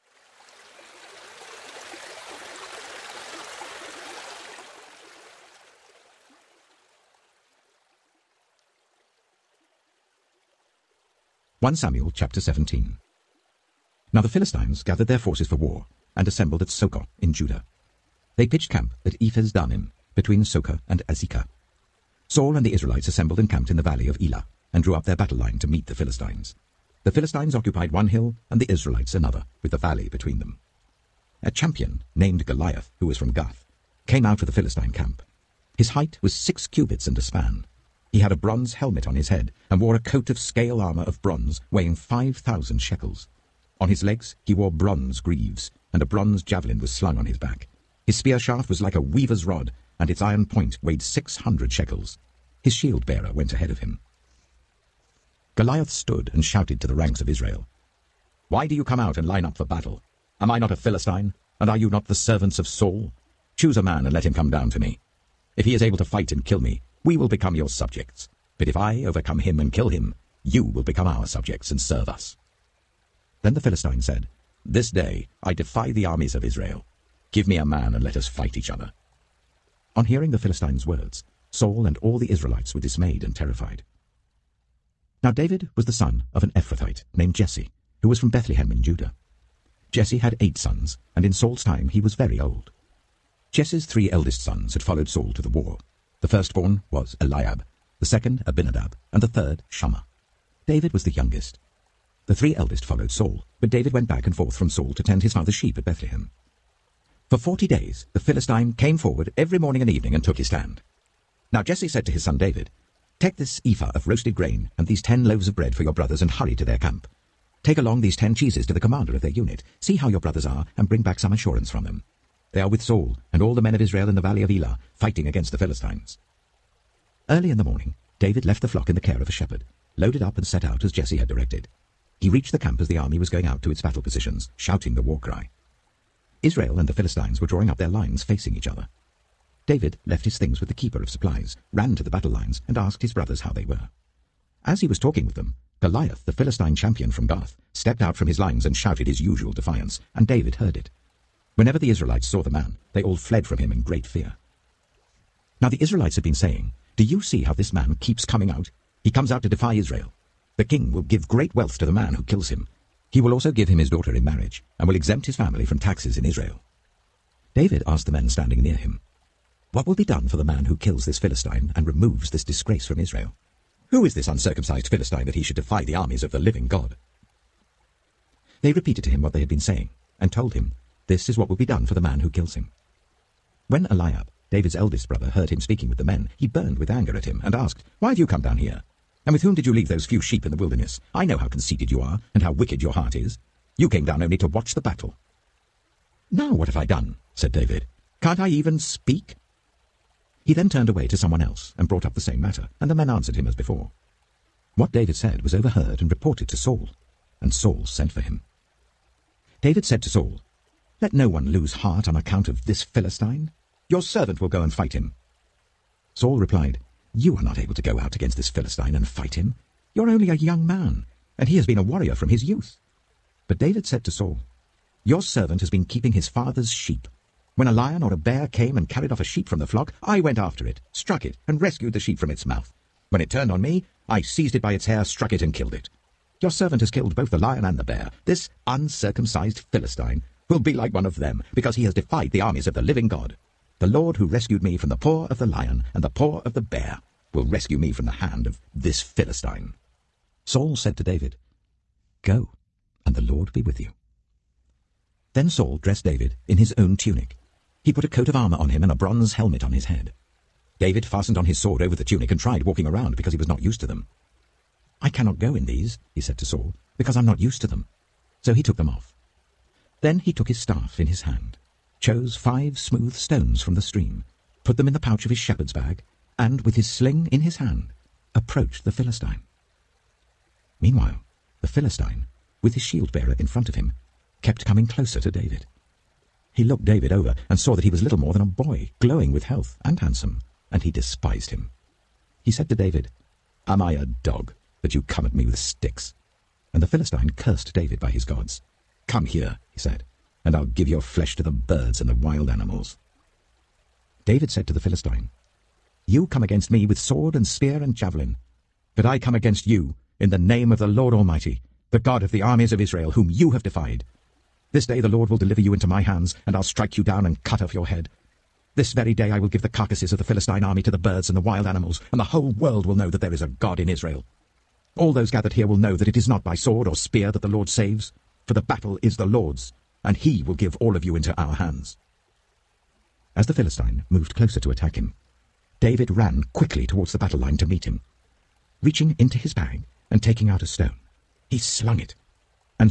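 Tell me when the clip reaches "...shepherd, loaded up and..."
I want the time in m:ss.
2:09.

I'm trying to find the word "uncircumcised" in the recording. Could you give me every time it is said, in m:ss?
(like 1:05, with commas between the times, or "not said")
2:54, 3:58.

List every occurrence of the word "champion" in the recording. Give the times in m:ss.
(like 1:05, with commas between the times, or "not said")
0:31, 2:26.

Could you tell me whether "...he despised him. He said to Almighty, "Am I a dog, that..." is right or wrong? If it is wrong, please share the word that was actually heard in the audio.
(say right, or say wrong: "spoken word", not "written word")
wrong: "David", not "Almighty".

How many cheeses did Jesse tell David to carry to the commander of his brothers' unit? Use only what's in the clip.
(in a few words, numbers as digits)
10.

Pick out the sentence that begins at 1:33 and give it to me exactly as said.
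Jesse's three eldest sons had followed Saul to the war.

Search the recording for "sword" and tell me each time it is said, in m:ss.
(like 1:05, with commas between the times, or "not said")
4:21, 5:06, 5:26.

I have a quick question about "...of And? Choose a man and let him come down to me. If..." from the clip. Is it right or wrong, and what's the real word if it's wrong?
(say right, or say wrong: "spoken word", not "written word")
wrong: "Saul", not "And".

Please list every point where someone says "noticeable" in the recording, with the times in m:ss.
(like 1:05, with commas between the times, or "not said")
not said.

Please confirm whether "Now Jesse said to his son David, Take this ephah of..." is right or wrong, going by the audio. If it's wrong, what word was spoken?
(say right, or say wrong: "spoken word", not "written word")
right.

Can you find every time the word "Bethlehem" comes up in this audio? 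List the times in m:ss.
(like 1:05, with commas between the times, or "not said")
1:28, 1:45.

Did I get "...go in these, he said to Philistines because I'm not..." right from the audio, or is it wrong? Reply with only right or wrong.
wrong.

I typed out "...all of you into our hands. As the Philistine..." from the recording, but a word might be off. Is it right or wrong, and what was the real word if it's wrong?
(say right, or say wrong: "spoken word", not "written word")
right.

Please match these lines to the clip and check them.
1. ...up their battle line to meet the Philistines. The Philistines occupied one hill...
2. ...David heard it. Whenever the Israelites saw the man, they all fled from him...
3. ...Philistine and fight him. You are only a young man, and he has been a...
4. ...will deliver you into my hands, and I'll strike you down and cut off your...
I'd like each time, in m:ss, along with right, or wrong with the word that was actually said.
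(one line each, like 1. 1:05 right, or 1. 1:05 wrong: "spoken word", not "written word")
1. 0:24 right
2. 2:30 right
3. 3:38 right
4. 5:15 right.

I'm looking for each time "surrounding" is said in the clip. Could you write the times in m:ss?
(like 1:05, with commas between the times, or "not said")
not said.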